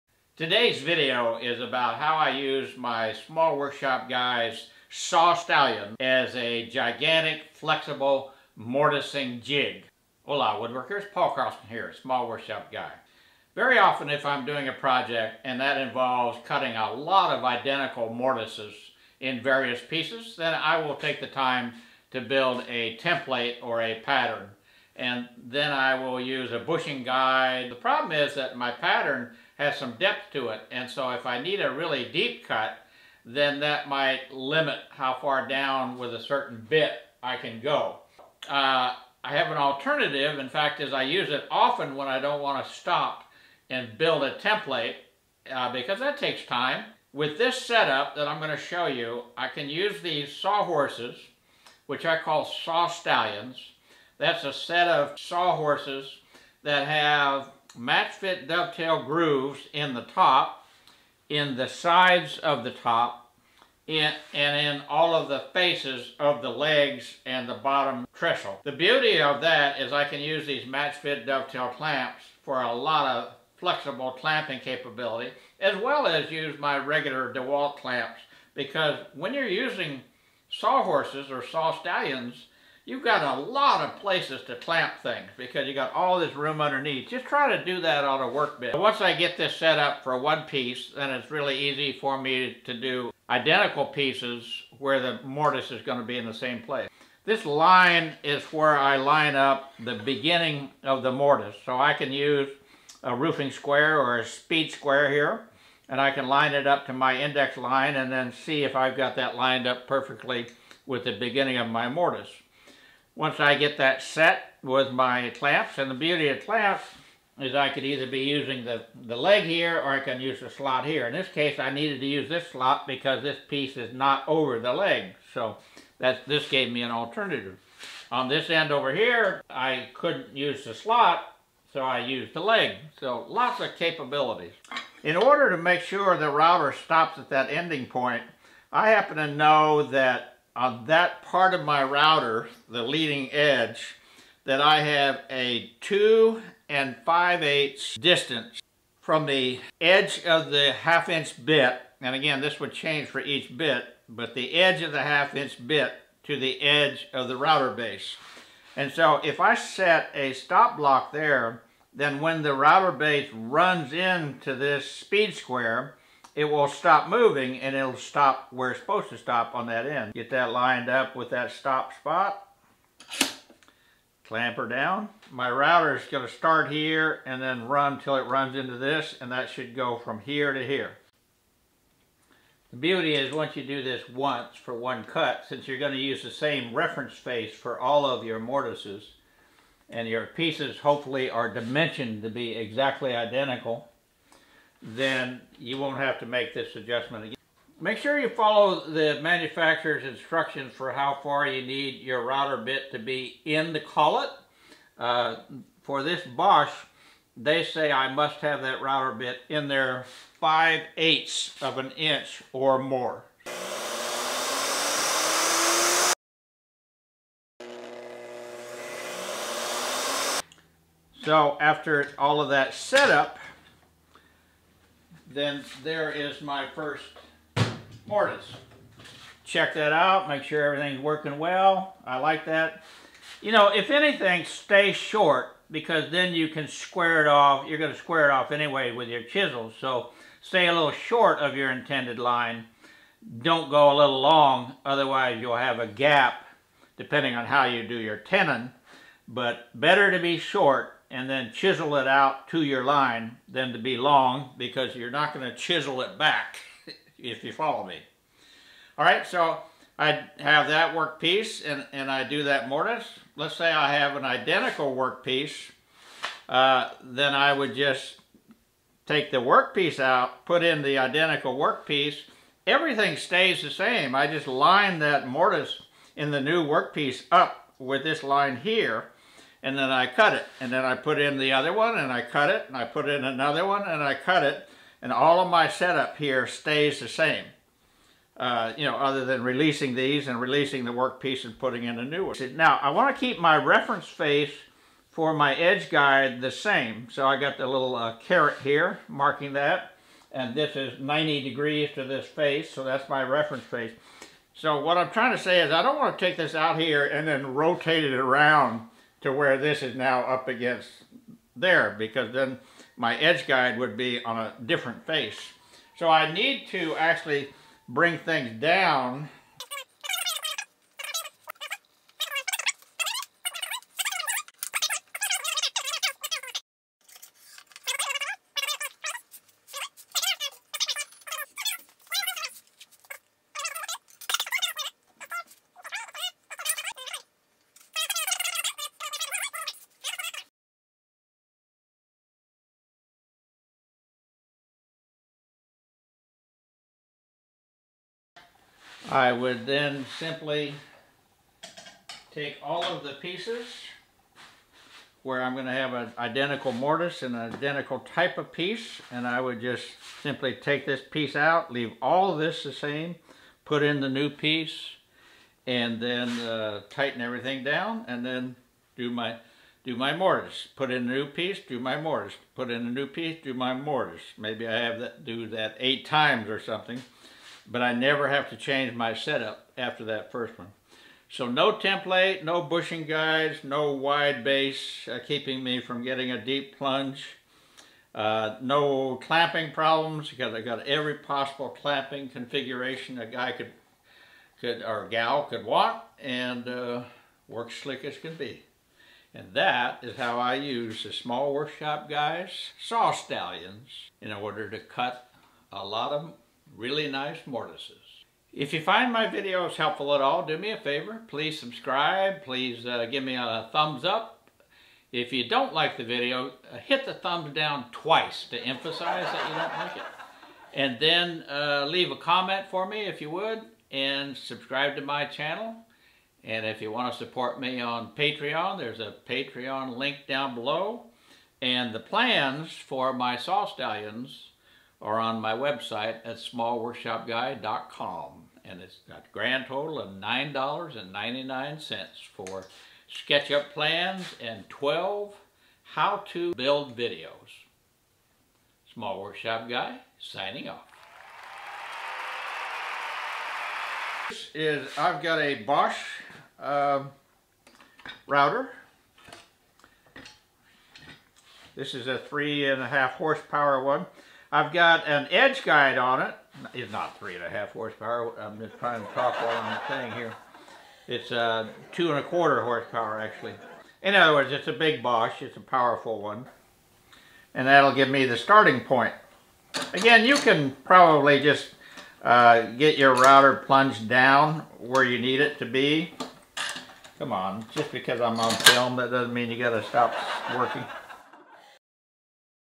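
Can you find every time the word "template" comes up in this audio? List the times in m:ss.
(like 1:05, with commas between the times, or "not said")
0:22, 0:44, 6:21.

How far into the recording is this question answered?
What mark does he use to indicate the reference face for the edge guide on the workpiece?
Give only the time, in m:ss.
4:58.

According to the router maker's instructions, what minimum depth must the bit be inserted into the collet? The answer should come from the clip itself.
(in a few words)
5/8 inch.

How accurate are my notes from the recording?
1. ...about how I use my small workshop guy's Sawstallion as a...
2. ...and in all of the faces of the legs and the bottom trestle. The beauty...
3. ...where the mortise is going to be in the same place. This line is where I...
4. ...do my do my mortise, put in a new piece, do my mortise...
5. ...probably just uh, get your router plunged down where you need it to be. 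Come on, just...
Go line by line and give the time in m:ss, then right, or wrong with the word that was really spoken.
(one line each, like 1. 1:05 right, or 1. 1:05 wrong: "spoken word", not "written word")
1. 0:01 right
2. 1:04 right
3. 1:34 right
4. 6:08 right
5. 8:00 right.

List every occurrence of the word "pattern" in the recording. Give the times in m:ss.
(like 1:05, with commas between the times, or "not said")
0:24, 0:28.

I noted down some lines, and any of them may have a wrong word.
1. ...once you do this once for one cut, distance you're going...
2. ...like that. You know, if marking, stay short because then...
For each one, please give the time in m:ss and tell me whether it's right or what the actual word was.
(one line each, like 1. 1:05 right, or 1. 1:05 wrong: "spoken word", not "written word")
1. 3:03 wrong: "since", not "distance"
2. 3:52 wrong: "anything", not "marking".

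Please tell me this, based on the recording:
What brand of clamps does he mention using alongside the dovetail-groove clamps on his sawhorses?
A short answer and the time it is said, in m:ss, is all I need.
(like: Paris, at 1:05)
DeWalt, at 1:17.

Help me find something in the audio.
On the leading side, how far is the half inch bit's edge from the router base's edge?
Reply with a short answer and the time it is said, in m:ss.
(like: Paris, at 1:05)
2 5/8 inches, at 2:25.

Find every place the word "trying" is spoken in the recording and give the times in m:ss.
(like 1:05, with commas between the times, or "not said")
5:05, 7:48.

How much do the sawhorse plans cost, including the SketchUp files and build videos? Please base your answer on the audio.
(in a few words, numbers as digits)
$9.99.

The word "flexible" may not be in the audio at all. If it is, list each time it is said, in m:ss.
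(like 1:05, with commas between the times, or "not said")
0:07, 1:13.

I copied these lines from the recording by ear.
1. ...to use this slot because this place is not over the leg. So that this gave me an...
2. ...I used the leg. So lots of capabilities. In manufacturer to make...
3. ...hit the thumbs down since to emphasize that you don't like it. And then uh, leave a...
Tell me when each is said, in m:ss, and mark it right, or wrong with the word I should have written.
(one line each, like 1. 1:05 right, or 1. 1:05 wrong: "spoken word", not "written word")
1. 2:01 wrong: "piece", not "place"
2. 2:11 wrong: "order", not "manufacturer"
3. 6:56 wrong: "twice", not "since".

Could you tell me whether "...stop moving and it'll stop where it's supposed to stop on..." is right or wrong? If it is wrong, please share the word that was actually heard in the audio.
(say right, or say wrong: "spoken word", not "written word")
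right.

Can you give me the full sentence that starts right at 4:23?
Let's say I have an identical workpiece, uh, then I would just take the workpiece out, put in the identical workpiece.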